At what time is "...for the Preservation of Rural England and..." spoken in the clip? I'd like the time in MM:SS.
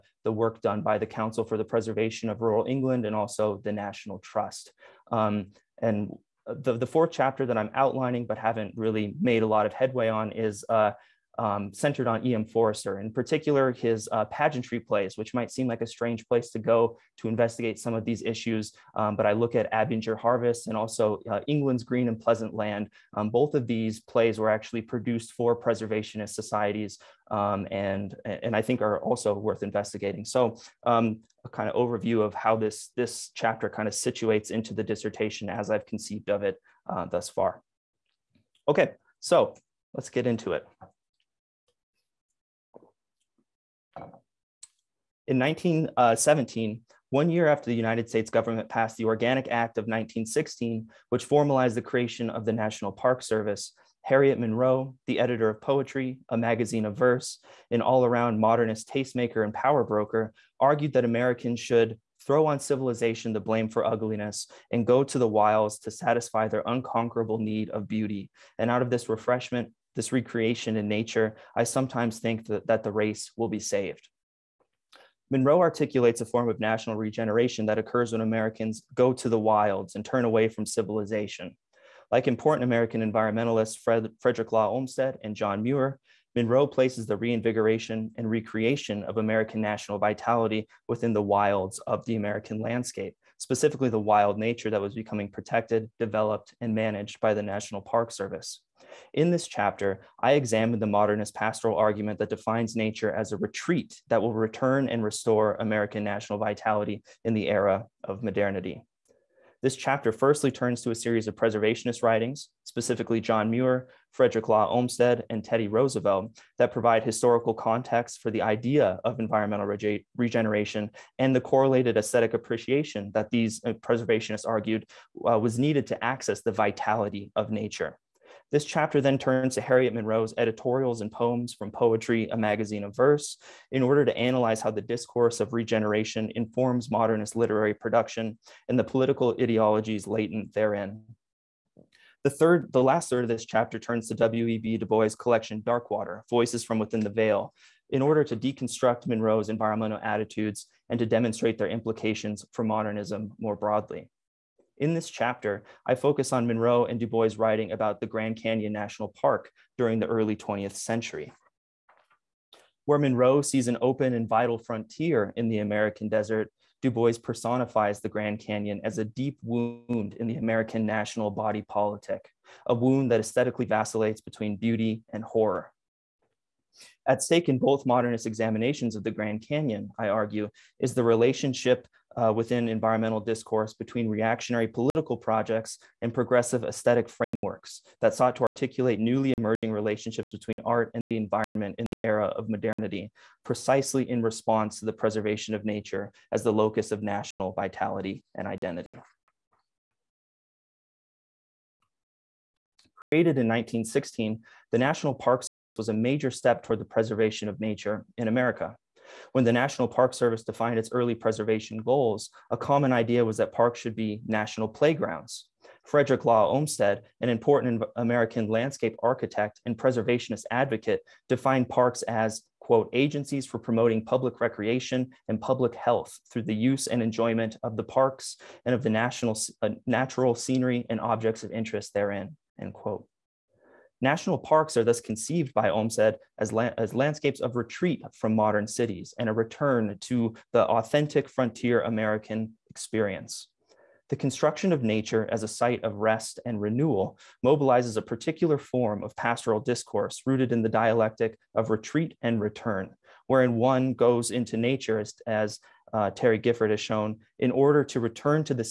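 00:01.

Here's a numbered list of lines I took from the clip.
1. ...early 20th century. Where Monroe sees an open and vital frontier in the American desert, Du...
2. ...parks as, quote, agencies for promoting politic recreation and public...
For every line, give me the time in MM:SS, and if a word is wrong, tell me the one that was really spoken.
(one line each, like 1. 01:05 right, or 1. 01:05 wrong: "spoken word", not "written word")
1. 02:40 right
2. 03:41 wrong: "public", not "politic".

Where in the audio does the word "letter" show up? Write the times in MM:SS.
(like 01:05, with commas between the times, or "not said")
not said.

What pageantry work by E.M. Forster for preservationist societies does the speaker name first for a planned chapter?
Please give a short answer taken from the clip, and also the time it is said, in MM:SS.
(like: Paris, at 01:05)
Abinger Harvest, at 00:19.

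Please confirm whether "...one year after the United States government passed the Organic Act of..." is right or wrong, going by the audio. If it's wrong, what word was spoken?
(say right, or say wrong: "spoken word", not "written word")
right.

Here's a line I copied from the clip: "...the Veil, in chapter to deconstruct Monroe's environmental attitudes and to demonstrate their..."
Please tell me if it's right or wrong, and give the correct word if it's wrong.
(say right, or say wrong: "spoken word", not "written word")
wrong: "order", not "chapter".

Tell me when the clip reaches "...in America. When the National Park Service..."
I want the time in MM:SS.
03:28.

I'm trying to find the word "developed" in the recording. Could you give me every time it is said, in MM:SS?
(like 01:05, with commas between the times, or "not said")
01:35.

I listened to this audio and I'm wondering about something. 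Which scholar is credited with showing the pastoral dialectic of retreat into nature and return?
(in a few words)
Terry Gifford.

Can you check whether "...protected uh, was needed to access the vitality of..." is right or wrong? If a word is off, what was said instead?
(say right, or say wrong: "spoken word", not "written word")
wrong: "argued", not "protected".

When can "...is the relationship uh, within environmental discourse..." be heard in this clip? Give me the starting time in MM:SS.
03:00.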